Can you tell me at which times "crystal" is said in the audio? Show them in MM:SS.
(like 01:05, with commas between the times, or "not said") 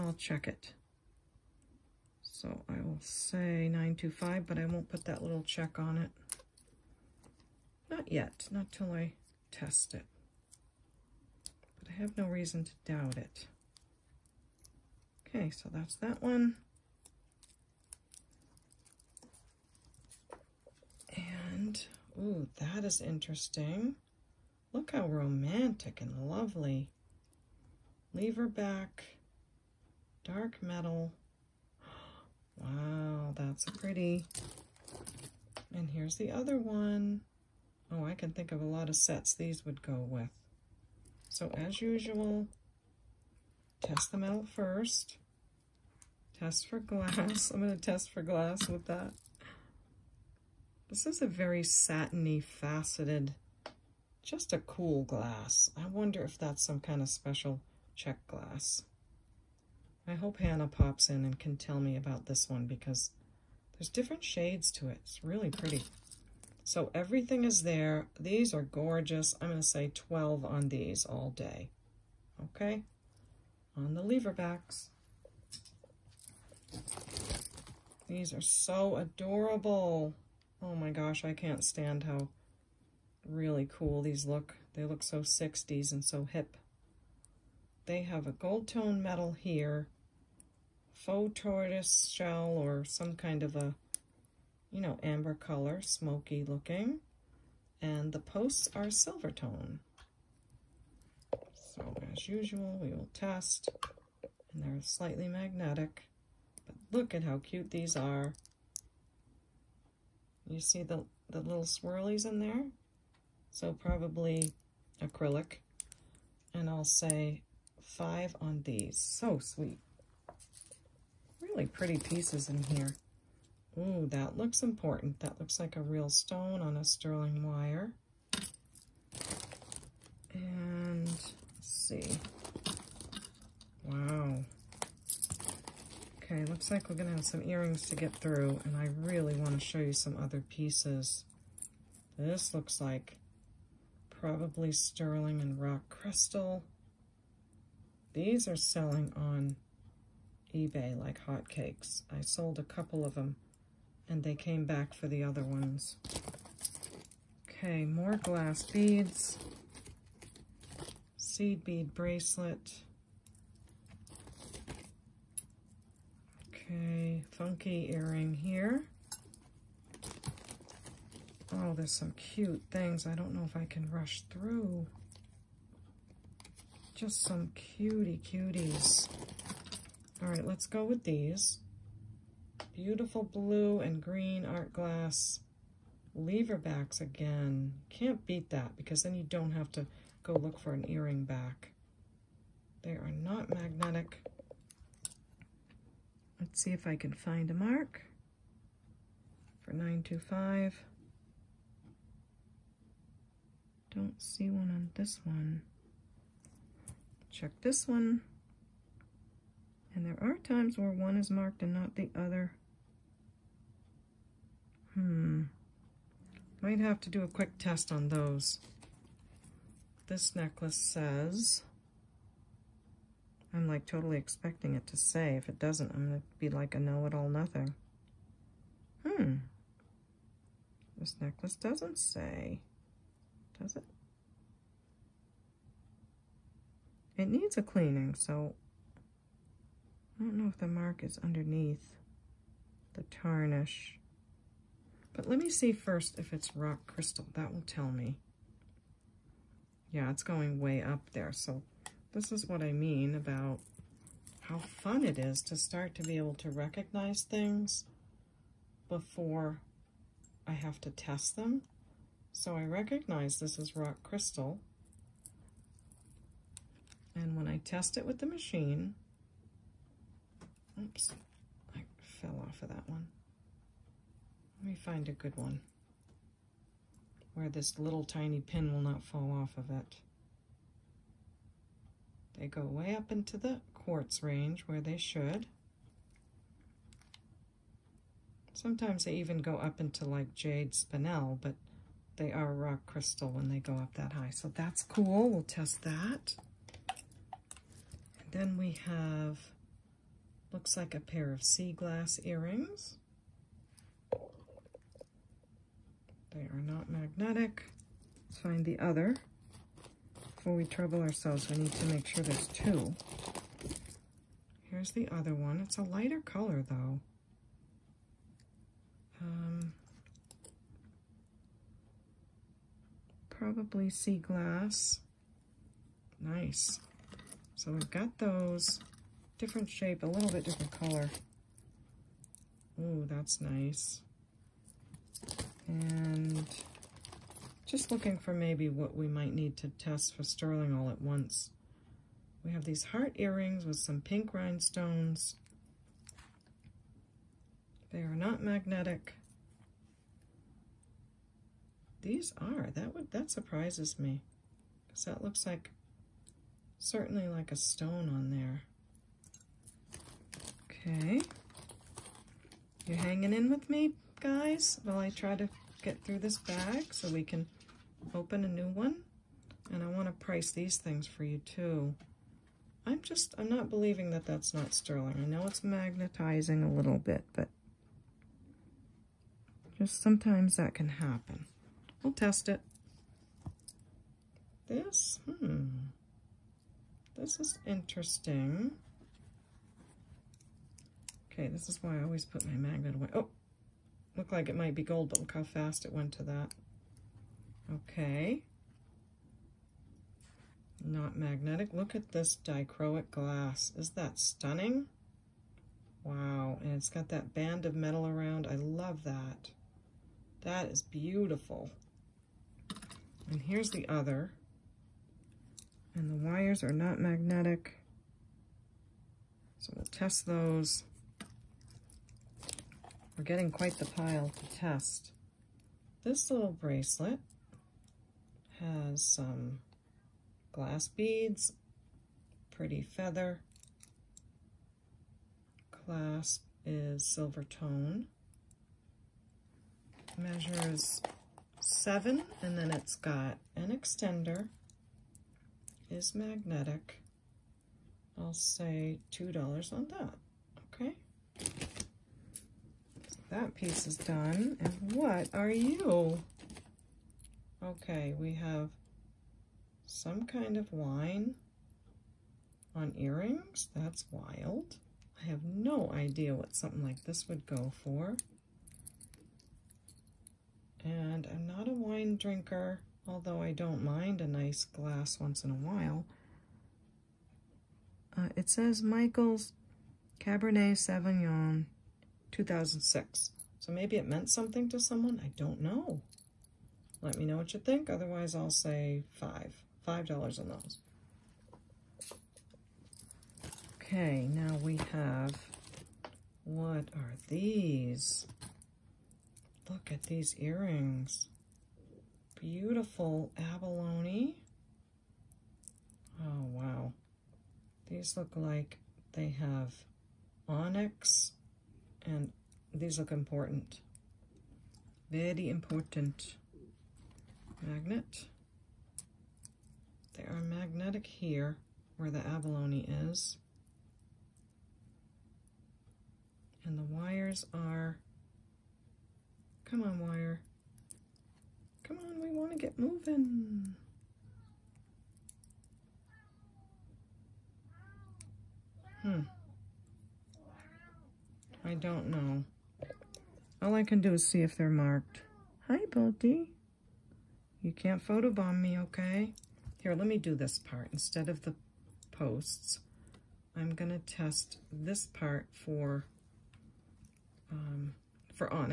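02:25, 04:06, 04:24, 04:52.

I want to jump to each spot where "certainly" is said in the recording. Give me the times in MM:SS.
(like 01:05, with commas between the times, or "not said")
05:56.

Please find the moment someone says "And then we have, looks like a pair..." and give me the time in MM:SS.
04:58.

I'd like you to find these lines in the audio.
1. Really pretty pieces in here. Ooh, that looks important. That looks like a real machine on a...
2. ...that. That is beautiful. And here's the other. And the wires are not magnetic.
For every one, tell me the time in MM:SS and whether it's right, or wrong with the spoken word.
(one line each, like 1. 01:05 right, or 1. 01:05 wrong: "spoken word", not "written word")
1. 02:01 wrong: "stone", not "machine"
2. 06:49 right.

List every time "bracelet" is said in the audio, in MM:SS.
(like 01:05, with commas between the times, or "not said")
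02:41, 07:06.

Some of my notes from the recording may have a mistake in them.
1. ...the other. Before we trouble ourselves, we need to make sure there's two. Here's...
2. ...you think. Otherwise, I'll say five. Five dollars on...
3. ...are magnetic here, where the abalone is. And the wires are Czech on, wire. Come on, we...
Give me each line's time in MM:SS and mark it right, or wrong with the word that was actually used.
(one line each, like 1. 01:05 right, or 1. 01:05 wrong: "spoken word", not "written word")
1. 05:08 right
2. 08:07 right
3. 08:40 wrong: "Come", not "Czech".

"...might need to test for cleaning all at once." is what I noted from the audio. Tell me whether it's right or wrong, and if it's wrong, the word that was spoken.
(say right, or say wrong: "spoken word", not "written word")
wrong: "sterling", not "cleaning".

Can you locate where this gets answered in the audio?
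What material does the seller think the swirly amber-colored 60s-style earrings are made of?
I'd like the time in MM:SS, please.
01:55.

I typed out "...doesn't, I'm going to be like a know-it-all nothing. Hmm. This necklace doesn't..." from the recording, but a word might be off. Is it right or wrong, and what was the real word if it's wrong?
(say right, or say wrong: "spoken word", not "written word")
right.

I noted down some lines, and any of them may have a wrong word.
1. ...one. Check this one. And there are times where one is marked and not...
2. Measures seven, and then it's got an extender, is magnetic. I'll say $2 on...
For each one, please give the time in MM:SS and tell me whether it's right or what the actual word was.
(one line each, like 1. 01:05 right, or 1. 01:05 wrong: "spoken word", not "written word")
1. 03:25 right
2. 07:20 right.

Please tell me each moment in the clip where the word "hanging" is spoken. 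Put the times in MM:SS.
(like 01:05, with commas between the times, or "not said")
06:02.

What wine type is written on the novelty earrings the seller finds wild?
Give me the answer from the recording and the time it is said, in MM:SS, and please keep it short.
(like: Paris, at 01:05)
Cabernet Sauvignon, at 08:00.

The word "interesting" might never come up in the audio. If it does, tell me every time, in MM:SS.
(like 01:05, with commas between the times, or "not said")
00:23, 06:27.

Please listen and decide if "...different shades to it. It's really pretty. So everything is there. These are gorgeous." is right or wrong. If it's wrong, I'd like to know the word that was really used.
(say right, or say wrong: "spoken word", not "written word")
right.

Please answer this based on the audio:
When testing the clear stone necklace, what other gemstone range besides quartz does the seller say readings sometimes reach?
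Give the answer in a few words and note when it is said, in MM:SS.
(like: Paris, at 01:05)
Jade spinel, at 04:50.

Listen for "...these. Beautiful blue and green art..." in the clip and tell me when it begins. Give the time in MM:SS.
03:01.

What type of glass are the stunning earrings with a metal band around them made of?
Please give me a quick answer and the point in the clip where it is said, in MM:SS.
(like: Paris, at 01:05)
Dichroic glass, at 06:42.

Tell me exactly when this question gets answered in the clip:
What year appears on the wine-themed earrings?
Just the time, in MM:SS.
08:02.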